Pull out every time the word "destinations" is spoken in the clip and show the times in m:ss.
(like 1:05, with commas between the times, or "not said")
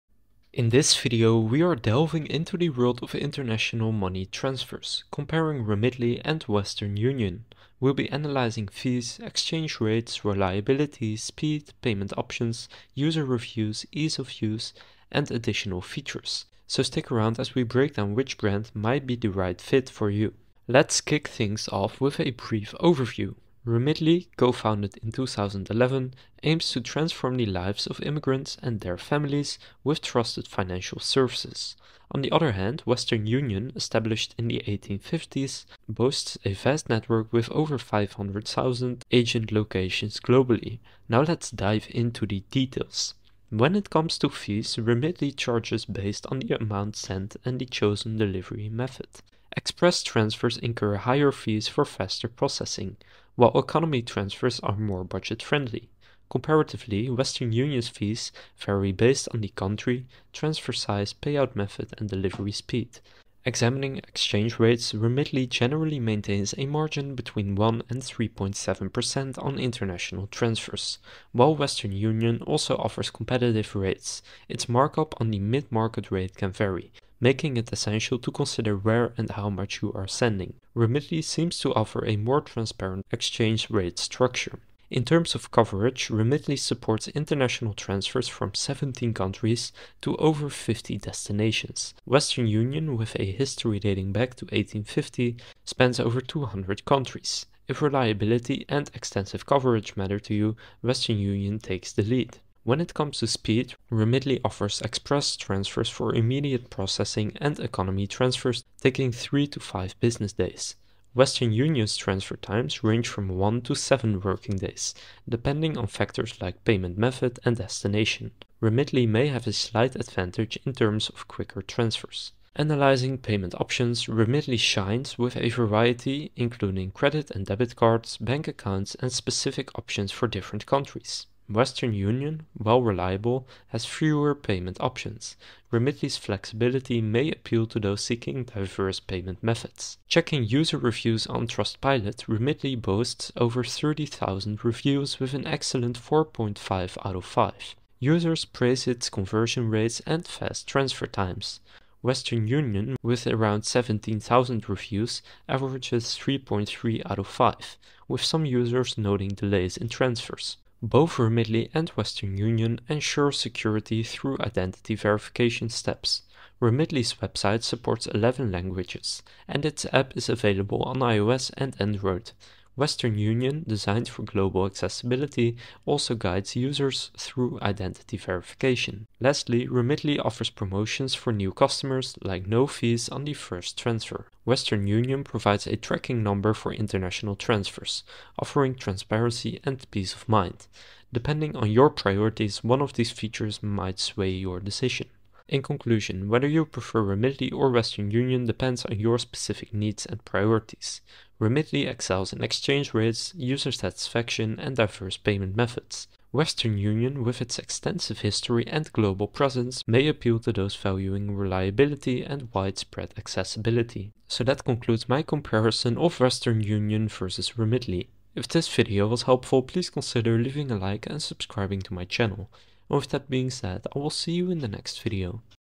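1:30, 1:57.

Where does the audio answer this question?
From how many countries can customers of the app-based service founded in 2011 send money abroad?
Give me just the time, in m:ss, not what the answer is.
1:28.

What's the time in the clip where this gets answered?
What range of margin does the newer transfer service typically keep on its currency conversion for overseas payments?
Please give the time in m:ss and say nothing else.
1:07.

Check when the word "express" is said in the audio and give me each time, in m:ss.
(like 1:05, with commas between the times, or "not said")
0:49, 1:44.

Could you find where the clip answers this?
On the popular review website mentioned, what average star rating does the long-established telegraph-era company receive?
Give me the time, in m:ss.
2:36.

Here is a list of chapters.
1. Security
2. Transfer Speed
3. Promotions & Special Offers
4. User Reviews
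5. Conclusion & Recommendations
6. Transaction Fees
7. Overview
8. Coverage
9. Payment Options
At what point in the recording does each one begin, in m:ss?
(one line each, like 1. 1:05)
1. 2:40
2. 1:42
3. 2:59
4. 2:19
5. 3:15
6. 0:43
7. 0:20
8. 1:24
9. 2:02.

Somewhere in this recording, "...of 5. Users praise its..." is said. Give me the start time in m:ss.
2:27.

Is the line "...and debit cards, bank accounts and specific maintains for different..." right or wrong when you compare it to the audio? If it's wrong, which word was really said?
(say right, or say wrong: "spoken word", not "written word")
wrong: "options", not "maintains".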